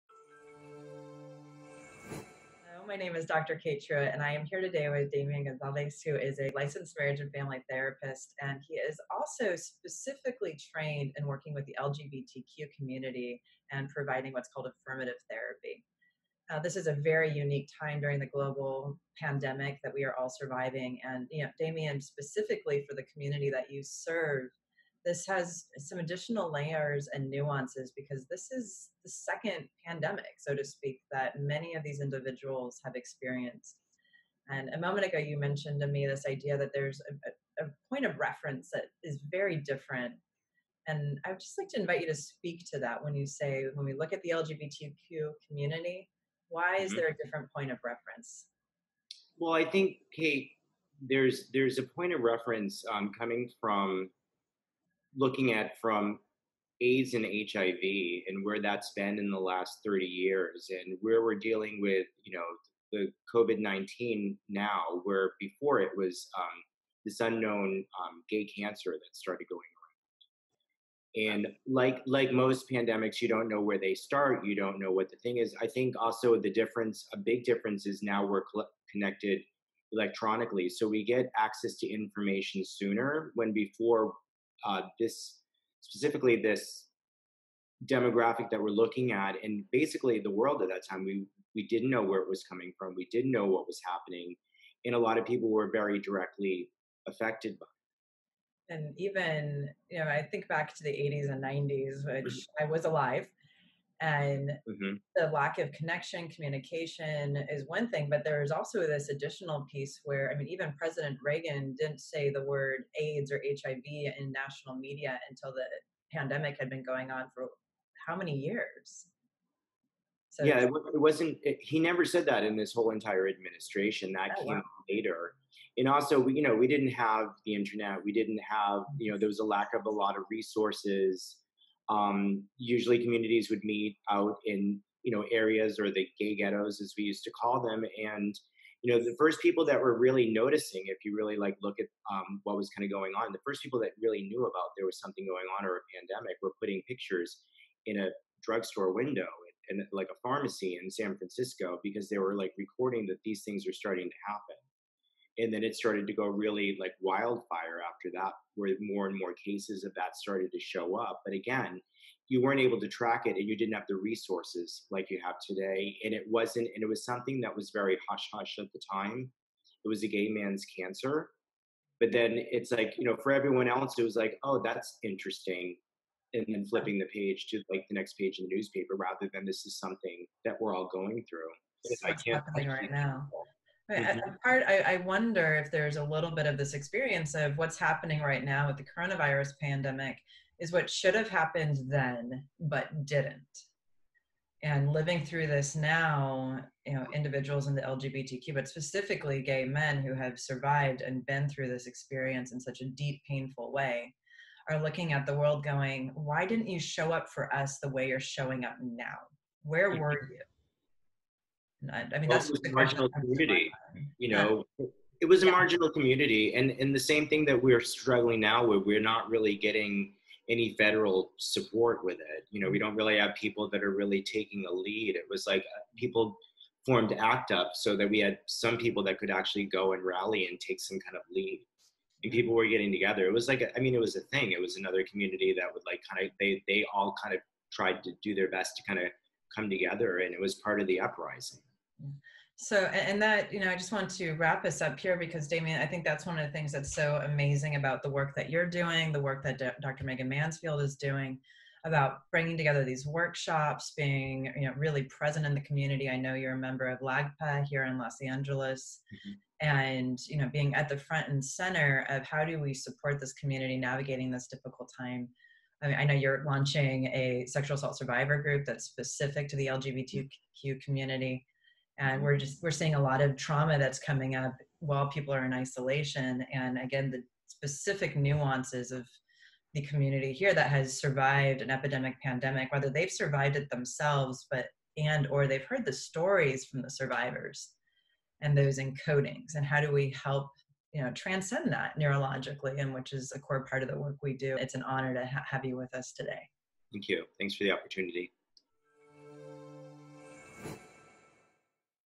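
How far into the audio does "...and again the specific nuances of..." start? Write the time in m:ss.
4:36.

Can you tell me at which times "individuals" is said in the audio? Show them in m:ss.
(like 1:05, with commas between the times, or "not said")
0:32, 3:17.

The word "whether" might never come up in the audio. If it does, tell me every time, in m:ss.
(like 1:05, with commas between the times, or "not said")
4:42.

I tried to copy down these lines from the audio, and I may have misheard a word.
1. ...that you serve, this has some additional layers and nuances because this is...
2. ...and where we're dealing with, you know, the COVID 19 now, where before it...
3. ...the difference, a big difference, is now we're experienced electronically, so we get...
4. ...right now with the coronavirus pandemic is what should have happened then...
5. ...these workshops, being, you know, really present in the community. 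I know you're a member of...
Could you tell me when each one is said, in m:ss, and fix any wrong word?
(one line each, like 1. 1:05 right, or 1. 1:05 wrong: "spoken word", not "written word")
1. 0:23 right
2. 1:00 right
3. 1:16 wrong: "connected", not "experienced"
4. 3:08 right
5. 4:12 right.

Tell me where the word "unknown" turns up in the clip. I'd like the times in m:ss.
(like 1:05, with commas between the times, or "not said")
1:07.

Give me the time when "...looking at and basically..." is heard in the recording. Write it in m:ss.
1:28.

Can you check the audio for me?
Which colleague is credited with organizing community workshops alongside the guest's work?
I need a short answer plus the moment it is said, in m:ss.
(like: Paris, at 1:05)
Dr. Megan Mansfield, at 4:09.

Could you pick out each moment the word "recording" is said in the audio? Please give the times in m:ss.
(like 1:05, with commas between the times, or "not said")
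2:32.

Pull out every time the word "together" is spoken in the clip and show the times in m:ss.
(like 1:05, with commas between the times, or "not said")
3:52, 3:59, 4:12.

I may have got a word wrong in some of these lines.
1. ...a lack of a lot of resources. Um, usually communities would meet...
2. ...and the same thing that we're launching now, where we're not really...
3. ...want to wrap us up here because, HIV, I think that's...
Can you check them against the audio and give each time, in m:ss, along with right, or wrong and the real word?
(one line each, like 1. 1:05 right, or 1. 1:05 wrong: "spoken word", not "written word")
1. 2:09 right
2. 3:36 wrong: "struggling", not "launching"
3. 4:03 wrong: "Damien", not "HIV".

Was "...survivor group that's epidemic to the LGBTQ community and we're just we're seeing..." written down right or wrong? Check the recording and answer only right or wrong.
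wrong.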